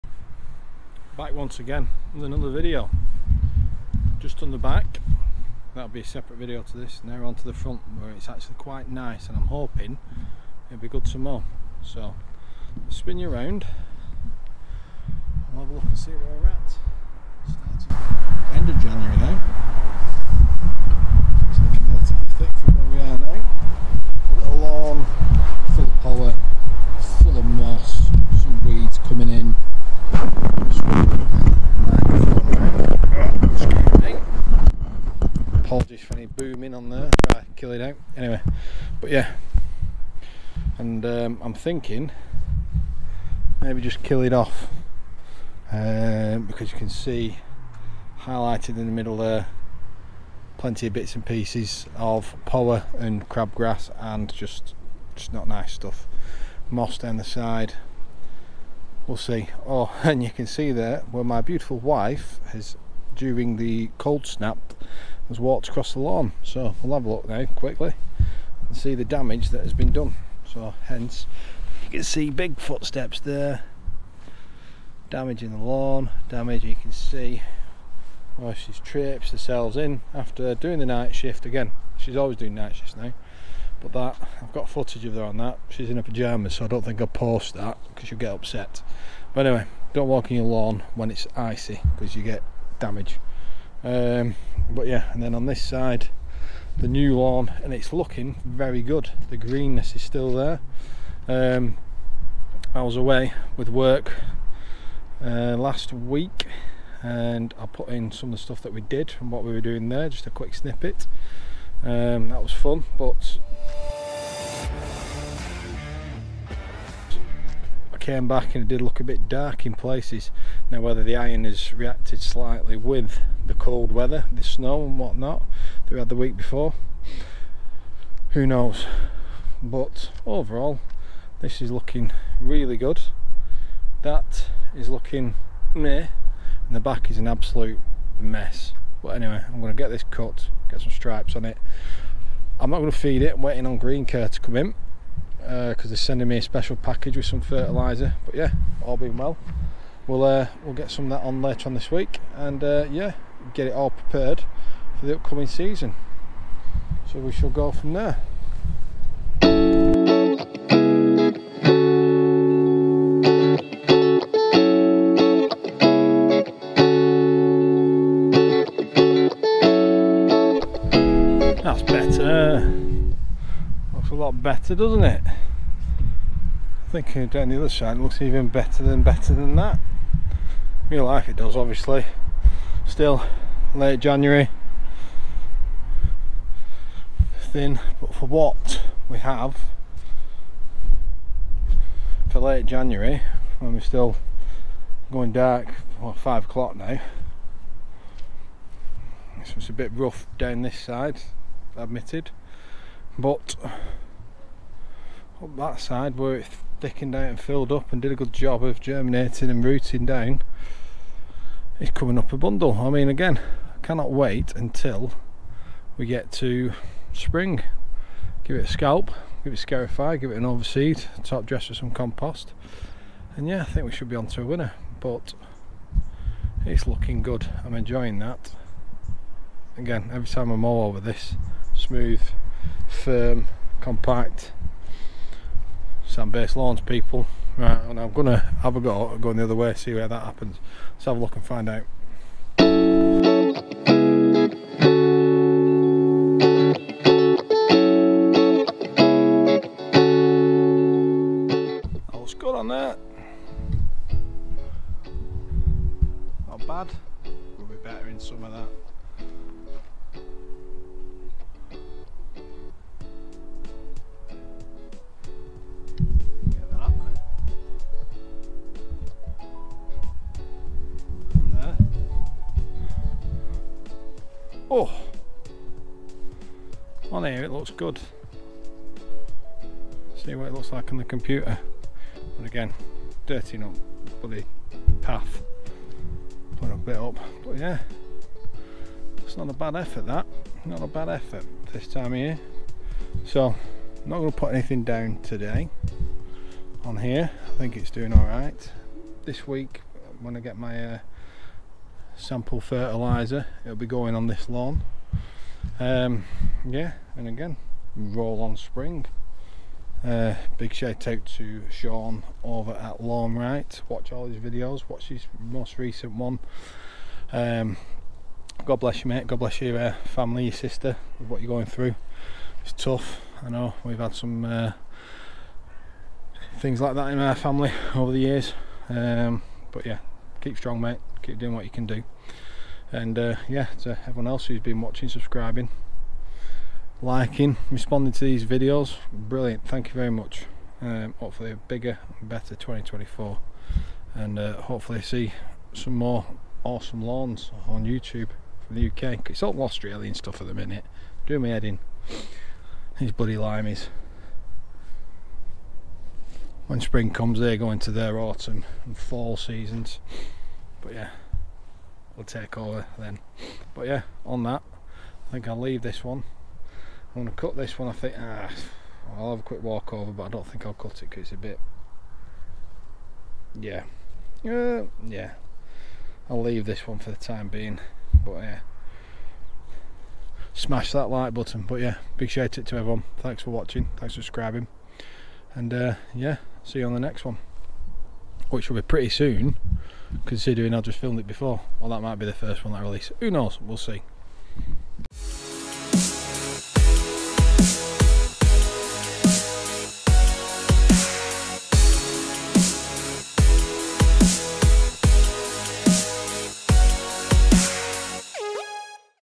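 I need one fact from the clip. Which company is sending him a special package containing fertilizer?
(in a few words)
Green Care.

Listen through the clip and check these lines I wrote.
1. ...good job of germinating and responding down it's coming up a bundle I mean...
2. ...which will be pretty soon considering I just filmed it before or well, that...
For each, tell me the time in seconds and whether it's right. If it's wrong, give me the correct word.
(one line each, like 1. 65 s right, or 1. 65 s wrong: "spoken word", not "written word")
1. 208 s wrong: "rooting", not "responding"
2. 388 s right.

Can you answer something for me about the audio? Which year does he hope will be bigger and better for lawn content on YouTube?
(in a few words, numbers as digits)
2024.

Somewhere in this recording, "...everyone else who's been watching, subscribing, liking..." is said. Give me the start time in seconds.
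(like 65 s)
334 s.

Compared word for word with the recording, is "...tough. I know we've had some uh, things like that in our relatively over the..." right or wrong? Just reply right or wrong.
wrong.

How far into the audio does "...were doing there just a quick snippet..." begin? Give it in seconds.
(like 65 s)
109 s.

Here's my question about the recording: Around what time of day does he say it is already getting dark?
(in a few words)
Five o'clock.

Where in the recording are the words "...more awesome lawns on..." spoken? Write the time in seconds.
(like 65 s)
345 s.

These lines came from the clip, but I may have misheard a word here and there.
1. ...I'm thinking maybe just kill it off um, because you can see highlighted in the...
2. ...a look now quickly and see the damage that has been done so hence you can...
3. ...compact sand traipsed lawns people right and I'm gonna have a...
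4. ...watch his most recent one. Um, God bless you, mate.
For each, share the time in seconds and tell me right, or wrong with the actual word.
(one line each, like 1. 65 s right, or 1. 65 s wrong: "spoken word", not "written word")
1. 41 s right
2. 67 s right
3. 233 s wrong: "based", not "traipsed"
4. 314 s right.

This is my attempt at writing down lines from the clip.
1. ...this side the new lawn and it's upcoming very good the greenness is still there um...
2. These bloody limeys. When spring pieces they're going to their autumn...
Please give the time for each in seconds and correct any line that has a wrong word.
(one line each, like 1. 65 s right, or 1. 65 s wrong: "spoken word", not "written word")
1. 95 s wrong: "looking", not "upcoming"
2. 352 s wrong: "comes", not "pieces".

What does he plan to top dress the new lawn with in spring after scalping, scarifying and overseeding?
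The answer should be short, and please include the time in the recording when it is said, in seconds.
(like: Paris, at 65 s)
Compost, at 221 s.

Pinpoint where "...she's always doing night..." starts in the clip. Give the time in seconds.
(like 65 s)
81 s.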